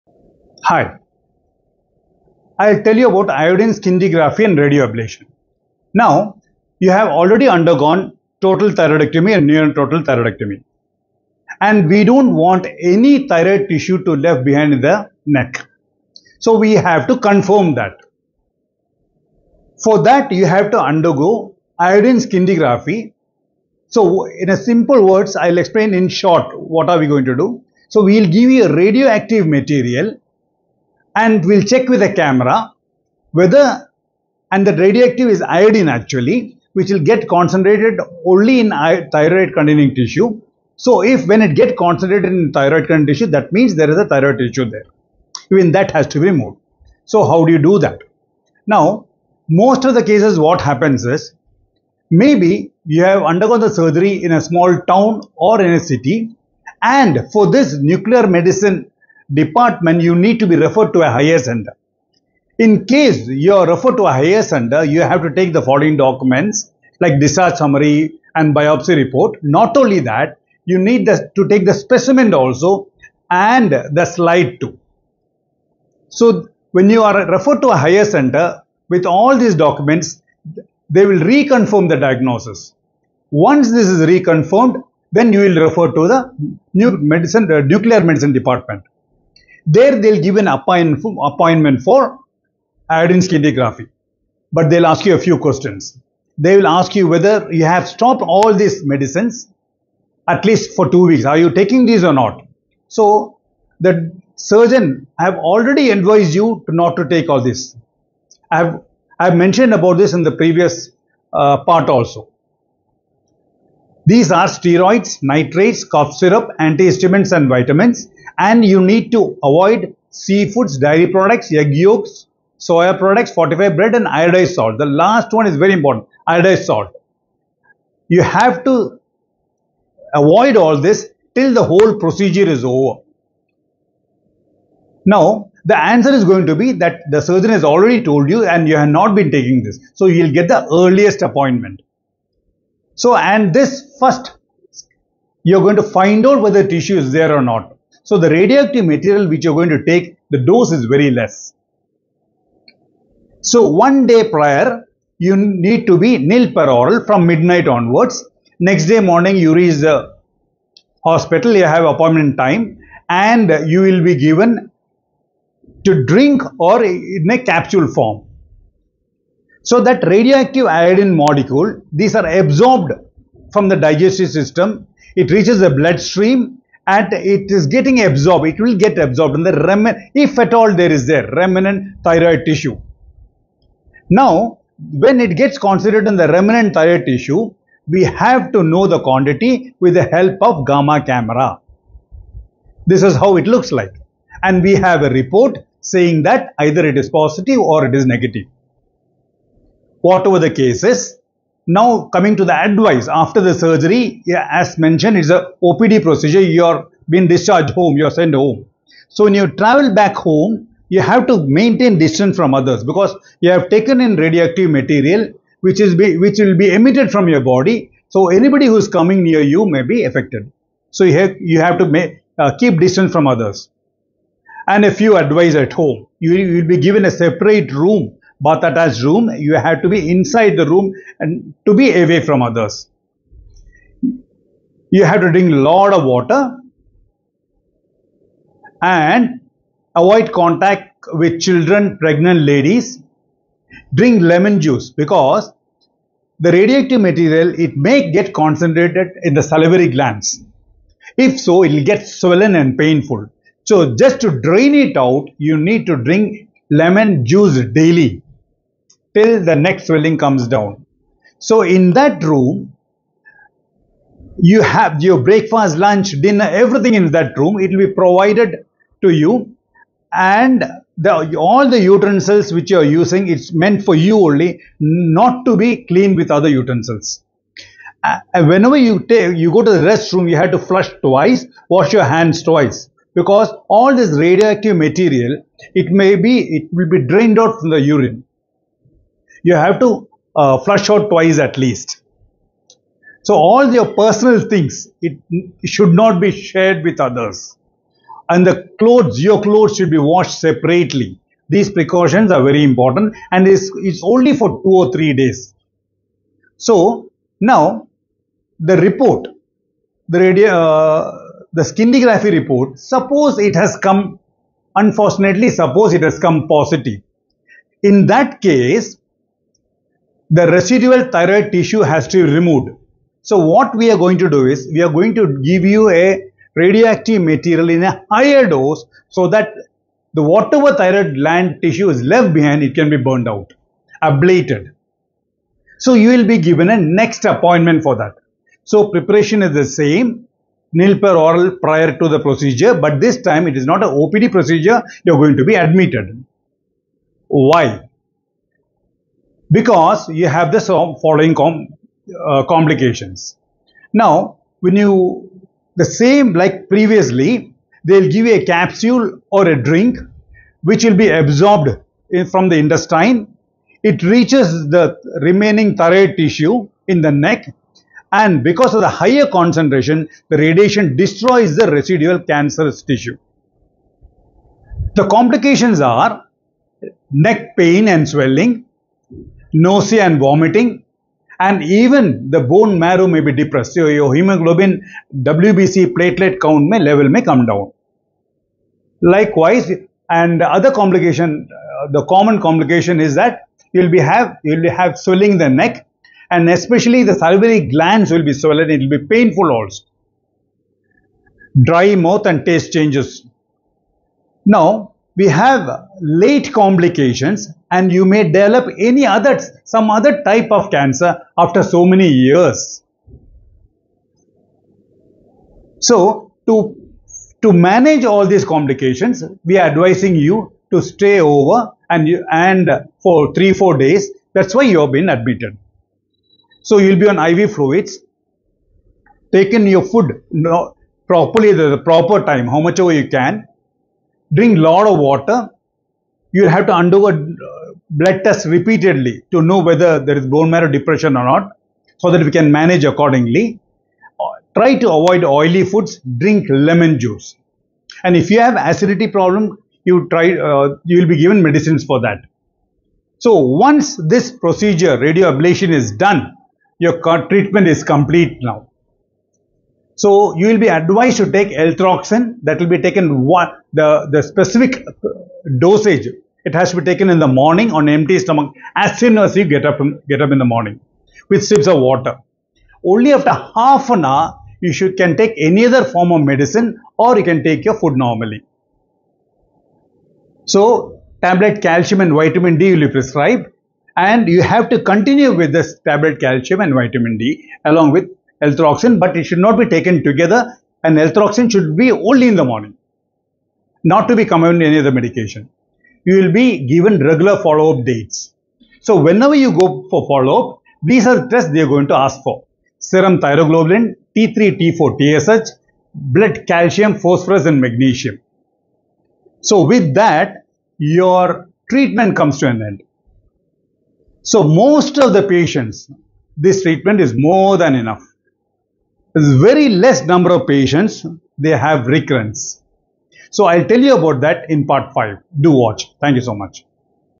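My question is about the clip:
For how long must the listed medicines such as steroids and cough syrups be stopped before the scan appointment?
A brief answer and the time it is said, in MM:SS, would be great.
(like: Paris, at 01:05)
2 weeks, at 01:40.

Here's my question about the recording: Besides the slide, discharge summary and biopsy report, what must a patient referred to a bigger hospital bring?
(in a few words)
The specimen.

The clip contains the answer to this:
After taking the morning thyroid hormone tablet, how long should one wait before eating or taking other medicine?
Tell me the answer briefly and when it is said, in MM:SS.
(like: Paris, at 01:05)
Half an hour, at 07:53.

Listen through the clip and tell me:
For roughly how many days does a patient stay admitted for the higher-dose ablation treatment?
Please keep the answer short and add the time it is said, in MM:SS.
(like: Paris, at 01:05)
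3 to 4 days, at 07:03.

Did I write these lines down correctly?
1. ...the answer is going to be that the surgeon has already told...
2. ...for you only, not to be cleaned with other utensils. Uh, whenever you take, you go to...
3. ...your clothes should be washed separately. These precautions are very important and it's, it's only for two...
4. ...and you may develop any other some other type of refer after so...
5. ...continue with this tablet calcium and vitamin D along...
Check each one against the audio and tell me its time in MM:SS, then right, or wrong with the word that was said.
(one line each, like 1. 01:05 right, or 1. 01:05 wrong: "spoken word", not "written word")
1. 02:15 right
2. 04:33 right
3. 04:59 right
4. 06:47 wrong: "cancer", not "refer"
5. 08:04 right.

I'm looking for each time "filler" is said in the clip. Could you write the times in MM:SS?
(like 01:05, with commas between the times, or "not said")
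not said.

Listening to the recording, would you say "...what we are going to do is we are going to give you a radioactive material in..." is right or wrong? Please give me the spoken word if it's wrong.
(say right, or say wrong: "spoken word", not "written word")
right.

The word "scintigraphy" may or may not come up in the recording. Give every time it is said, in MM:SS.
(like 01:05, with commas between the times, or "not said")
00:03, 00:22, 01:33, 05:11.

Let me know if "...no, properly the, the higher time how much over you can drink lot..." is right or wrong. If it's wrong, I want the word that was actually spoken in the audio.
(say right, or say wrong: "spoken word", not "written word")
wrong: "proper", not "higher".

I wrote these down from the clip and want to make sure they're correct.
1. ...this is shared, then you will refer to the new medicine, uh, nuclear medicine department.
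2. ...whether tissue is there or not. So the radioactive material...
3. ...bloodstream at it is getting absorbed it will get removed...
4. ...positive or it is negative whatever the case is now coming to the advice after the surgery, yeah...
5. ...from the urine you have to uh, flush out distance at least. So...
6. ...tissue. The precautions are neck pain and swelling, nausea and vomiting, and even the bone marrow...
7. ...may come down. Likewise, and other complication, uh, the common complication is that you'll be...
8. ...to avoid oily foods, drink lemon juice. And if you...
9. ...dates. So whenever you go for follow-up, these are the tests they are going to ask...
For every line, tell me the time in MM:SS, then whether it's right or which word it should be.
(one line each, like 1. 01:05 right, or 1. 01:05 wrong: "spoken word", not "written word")
1. 01:23 wrong: "reconfirmed", not "shared"
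2. 02:26 right
3. 02:55 wrong: "absorbed", not "removed"
4. 03:17 right
5. 04:47 wrong: "twice", not "distance"
6. 06:12 wrong: "complications", not "precautions"
7. 06:27 right
8. 07:24 right
9. 08:17 right.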